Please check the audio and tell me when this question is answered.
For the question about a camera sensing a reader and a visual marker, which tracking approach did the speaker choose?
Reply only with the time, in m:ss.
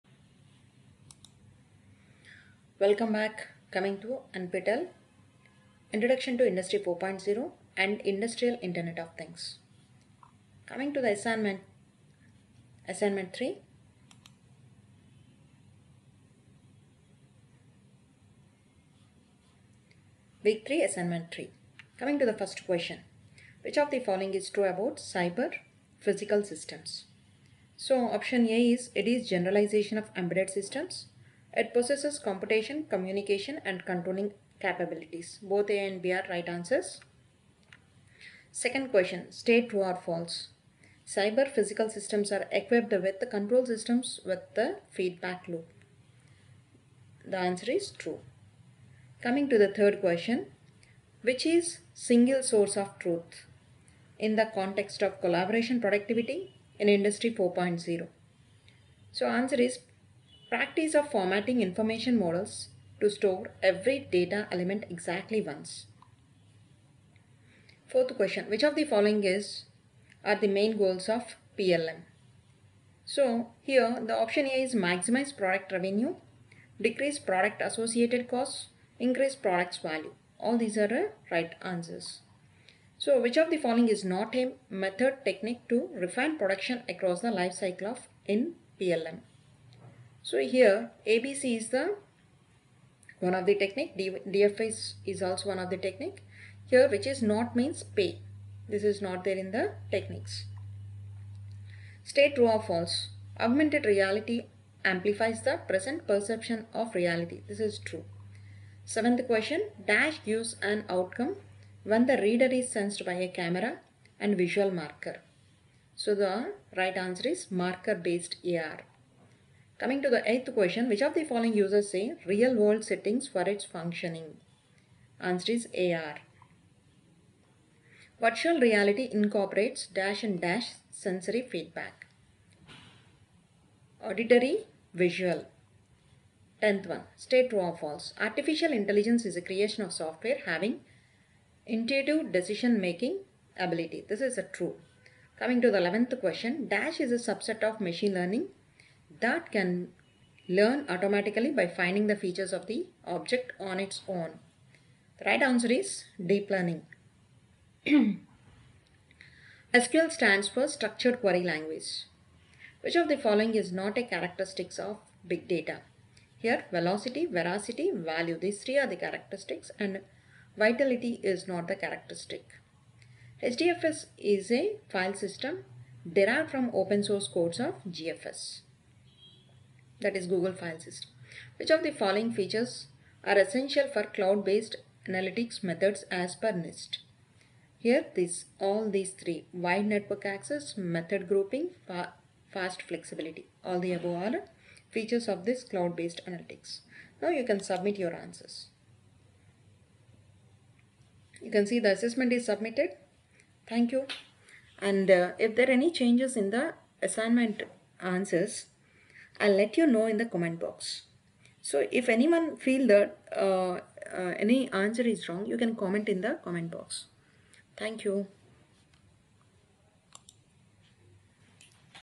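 1:57.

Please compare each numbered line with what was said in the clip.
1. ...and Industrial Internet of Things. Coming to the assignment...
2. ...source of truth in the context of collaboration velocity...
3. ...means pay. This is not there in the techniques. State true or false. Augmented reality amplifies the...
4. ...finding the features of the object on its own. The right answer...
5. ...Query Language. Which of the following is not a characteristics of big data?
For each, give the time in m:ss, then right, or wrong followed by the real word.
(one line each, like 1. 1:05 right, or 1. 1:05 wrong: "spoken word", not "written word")
1. 0:07 right
2. 0:52 wrong: "productivity", not "velocity"
3. 1:37 right
4. 2:31 right
5. 2:41 right.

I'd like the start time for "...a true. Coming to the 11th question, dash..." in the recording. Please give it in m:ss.
2:24.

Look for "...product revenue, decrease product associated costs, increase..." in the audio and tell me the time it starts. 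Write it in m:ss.
1:15.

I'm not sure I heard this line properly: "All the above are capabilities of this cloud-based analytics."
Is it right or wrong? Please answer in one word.
wrong.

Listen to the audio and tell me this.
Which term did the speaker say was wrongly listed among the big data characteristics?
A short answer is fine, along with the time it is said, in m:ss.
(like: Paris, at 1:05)
Vitality, at 2:50.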